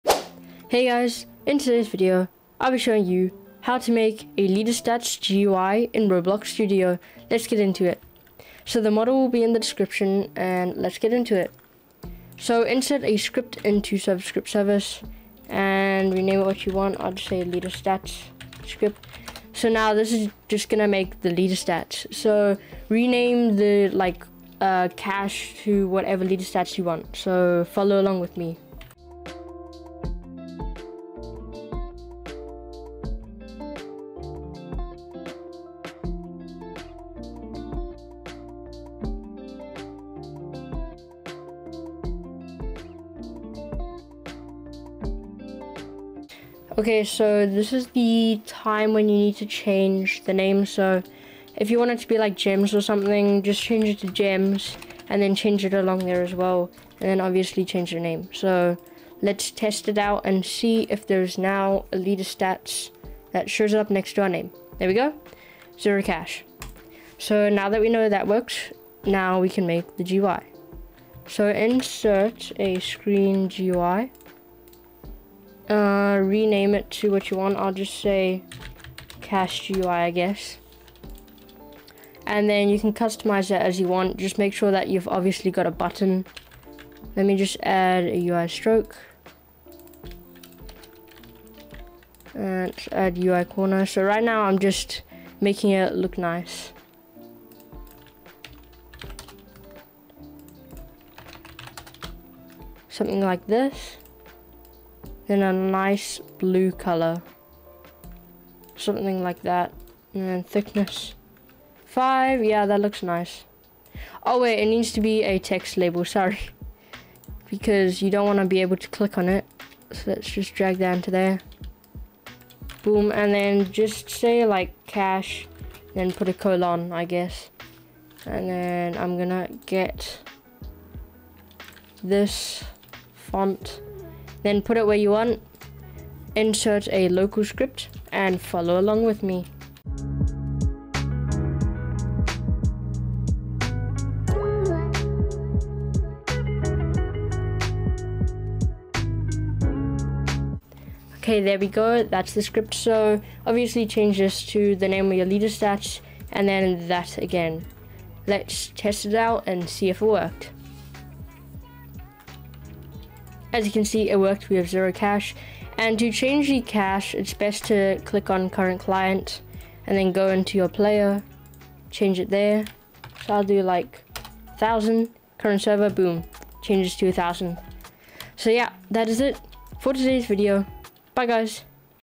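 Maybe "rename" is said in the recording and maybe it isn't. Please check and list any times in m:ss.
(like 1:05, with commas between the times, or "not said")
0:16, 0:22, 1:16.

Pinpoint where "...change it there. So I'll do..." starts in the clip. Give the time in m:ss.
2:51.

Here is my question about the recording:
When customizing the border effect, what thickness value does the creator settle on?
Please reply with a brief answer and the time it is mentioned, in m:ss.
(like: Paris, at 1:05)
5, at 1:51.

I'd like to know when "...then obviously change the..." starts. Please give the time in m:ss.
0:57.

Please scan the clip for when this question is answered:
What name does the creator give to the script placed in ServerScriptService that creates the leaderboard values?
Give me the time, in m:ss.
0:17.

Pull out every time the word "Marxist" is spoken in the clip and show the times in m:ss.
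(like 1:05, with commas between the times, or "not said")
not said.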